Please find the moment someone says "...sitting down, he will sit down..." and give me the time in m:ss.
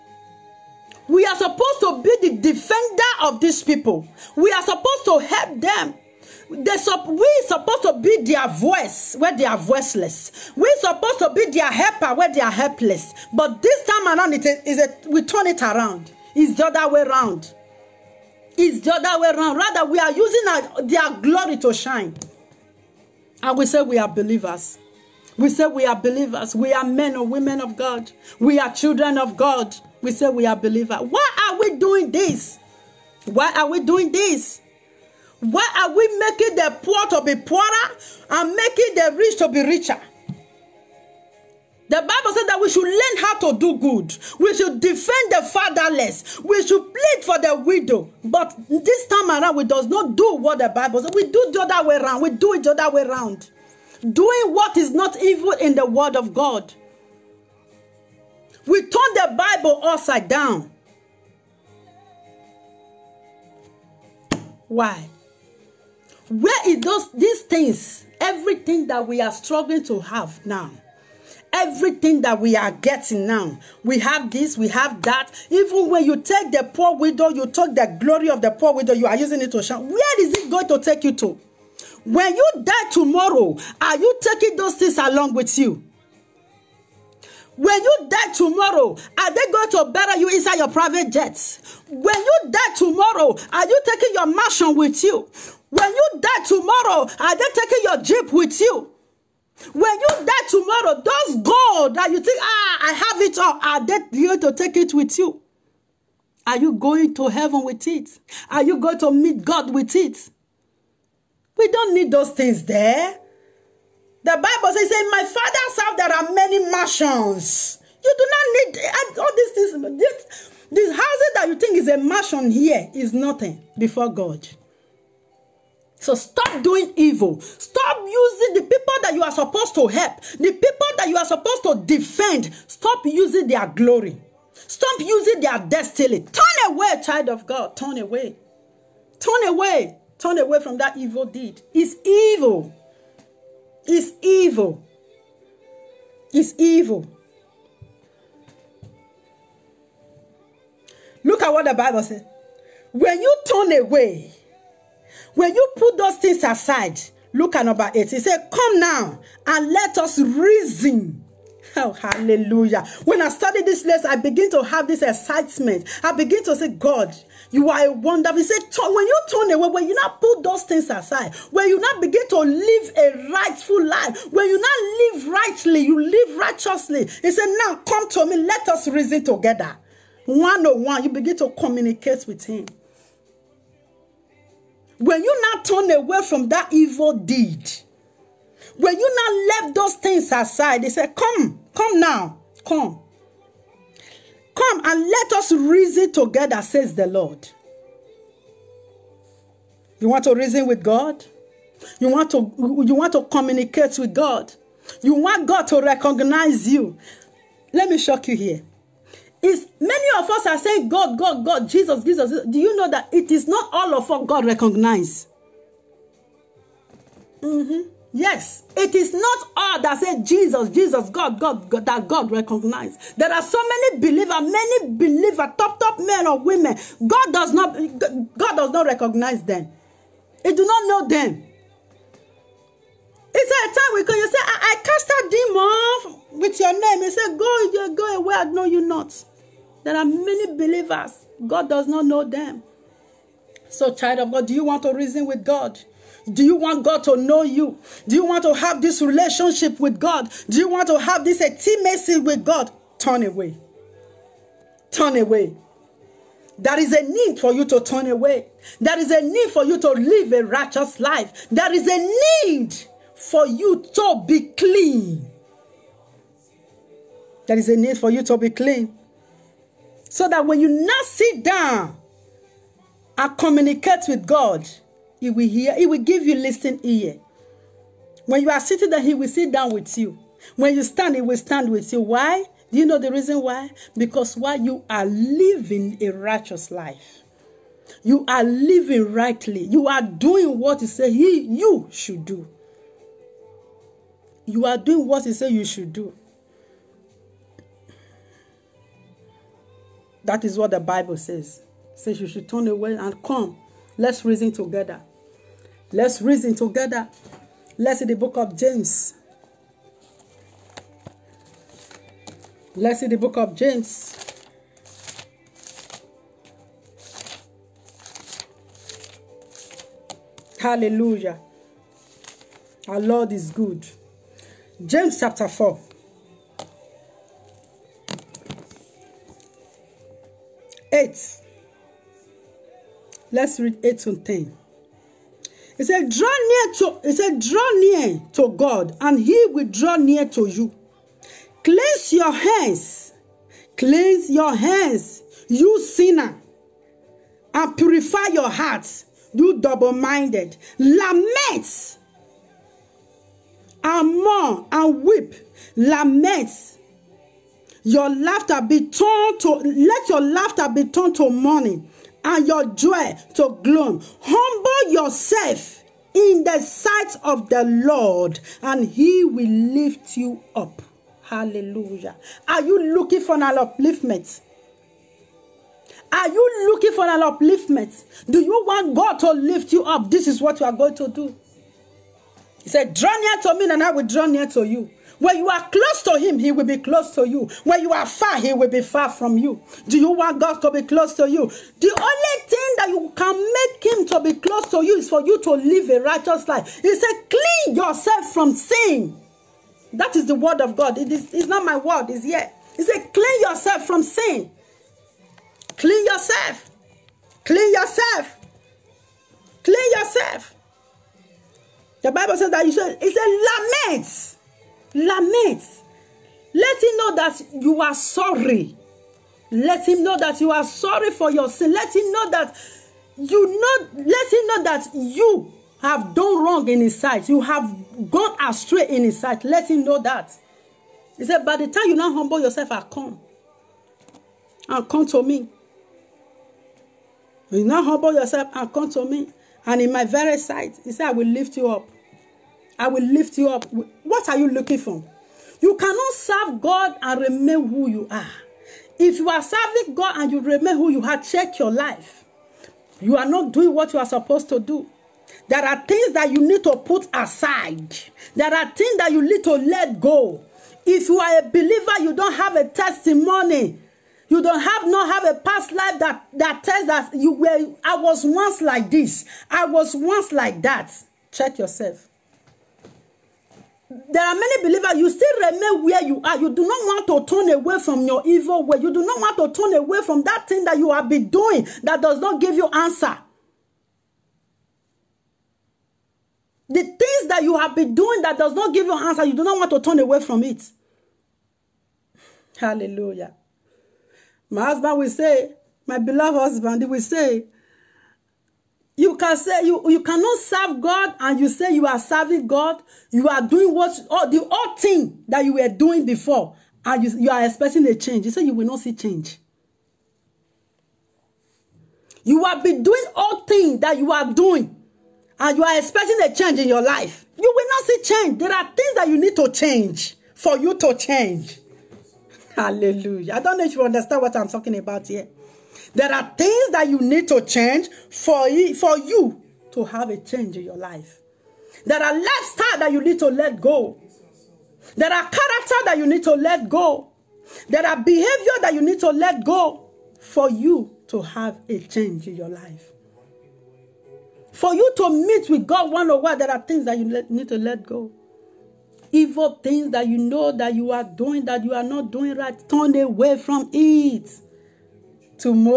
4:38.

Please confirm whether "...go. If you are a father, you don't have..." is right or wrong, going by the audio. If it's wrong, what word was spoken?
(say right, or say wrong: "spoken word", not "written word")
wrong: "believer", not "father".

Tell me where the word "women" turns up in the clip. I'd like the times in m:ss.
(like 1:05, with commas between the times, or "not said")
0:27, 3:46.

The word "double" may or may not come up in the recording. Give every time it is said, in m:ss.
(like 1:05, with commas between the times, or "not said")
5:49.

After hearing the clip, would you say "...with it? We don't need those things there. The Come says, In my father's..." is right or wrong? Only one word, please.
wrong.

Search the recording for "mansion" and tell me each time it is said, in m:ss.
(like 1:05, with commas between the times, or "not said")
1:34, 1:56, 2:01.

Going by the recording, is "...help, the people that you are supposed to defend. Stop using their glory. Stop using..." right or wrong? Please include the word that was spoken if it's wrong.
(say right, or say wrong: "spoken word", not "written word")
right.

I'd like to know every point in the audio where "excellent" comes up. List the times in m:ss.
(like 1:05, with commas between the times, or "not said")
not said.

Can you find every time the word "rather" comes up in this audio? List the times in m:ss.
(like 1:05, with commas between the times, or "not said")
0:19.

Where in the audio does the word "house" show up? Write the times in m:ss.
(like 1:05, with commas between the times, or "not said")
1:55, 2:00.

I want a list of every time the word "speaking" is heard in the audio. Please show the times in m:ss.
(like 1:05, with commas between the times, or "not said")
not said.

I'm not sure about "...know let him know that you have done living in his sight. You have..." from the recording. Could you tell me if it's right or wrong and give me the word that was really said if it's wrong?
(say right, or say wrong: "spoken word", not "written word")
wrong: "wrong", not "living".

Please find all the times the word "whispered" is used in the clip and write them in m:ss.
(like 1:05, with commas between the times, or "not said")
not said.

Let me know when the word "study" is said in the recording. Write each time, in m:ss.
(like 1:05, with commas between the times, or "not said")
2:43.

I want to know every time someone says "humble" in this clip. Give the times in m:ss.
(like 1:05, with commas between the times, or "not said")
6:04, 7:12, 7:17.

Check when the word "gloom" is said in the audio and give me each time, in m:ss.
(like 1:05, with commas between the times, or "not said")
6:03.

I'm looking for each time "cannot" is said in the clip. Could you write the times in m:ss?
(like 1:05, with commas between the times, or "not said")
7:25, 8:20.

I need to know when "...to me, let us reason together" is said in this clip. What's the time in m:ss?
2:58.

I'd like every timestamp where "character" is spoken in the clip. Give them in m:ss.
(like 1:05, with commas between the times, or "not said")
8:55.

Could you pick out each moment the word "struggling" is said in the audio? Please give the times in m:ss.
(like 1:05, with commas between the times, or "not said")
1:09.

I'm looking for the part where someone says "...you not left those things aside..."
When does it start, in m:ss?
3:08.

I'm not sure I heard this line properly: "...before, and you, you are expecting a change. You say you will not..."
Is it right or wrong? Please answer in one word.
right.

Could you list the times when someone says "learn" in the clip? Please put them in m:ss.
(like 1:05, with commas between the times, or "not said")
0:42.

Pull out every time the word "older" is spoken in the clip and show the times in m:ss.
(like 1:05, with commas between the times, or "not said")
not said.